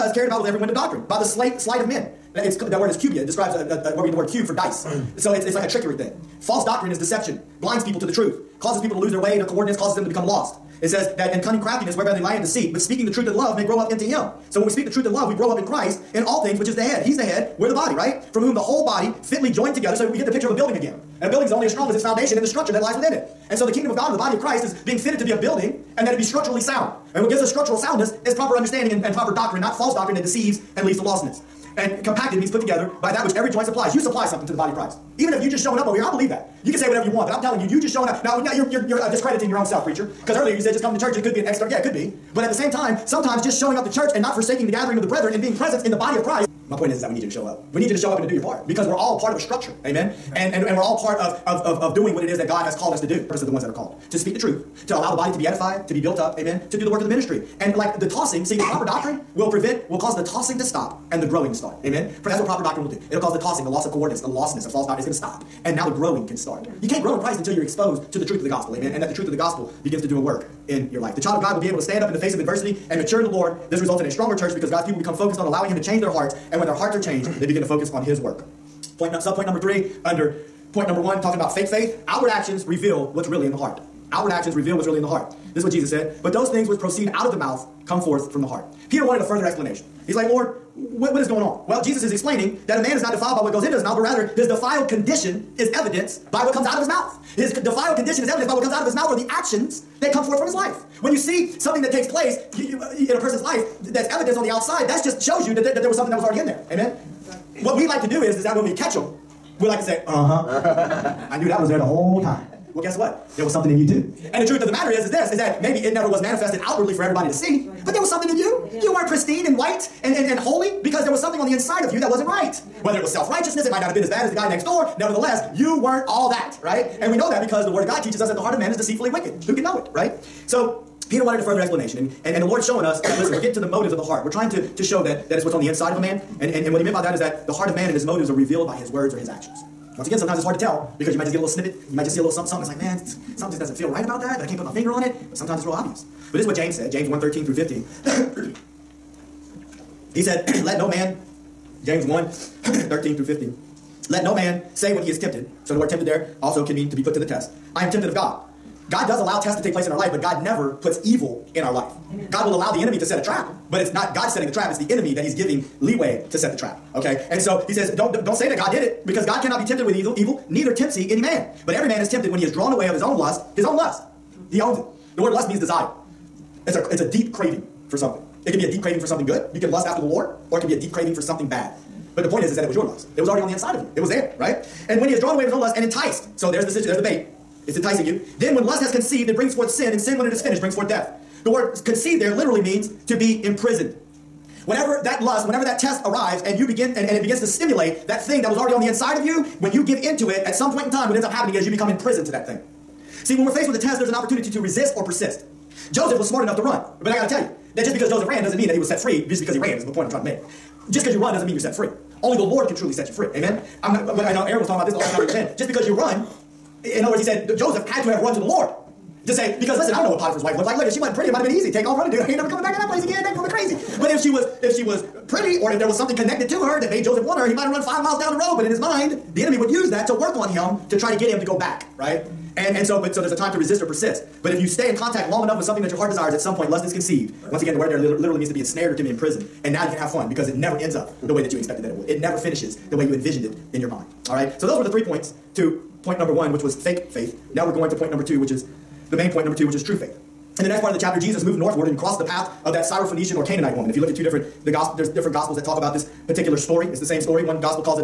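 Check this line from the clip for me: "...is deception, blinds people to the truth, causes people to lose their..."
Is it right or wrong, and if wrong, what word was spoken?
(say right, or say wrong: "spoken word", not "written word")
right.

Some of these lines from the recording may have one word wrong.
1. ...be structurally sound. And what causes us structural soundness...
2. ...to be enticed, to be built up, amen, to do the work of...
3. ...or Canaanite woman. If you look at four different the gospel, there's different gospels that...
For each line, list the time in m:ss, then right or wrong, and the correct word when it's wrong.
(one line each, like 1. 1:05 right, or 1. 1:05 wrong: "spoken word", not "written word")
1. 0:26 wrong: "gives", not "causes"
2. 0:55 wrong: "edified", not "enticed"
3. 4:13 wrong: "two", not "four".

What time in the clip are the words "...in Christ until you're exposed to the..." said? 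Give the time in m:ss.
1:07.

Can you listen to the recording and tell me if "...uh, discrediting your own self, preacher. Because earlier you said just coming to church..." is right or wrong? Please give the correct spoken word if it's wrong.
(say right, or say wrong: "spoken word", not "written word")
right.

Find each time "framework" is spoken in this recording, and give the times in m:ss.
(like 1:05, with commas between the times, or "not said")
not said.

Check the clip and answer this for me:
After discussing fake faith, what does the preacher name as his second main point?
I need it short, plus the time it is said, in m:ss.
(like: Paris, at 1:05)
true faith, at 4:09.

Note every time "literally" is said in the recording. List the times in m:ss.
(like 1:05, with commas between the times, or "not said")
3:12, 3:57.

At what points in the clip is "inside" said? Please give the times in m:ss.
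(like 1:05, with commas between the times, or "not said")
2:01, 2:15, 3:03, 3:18.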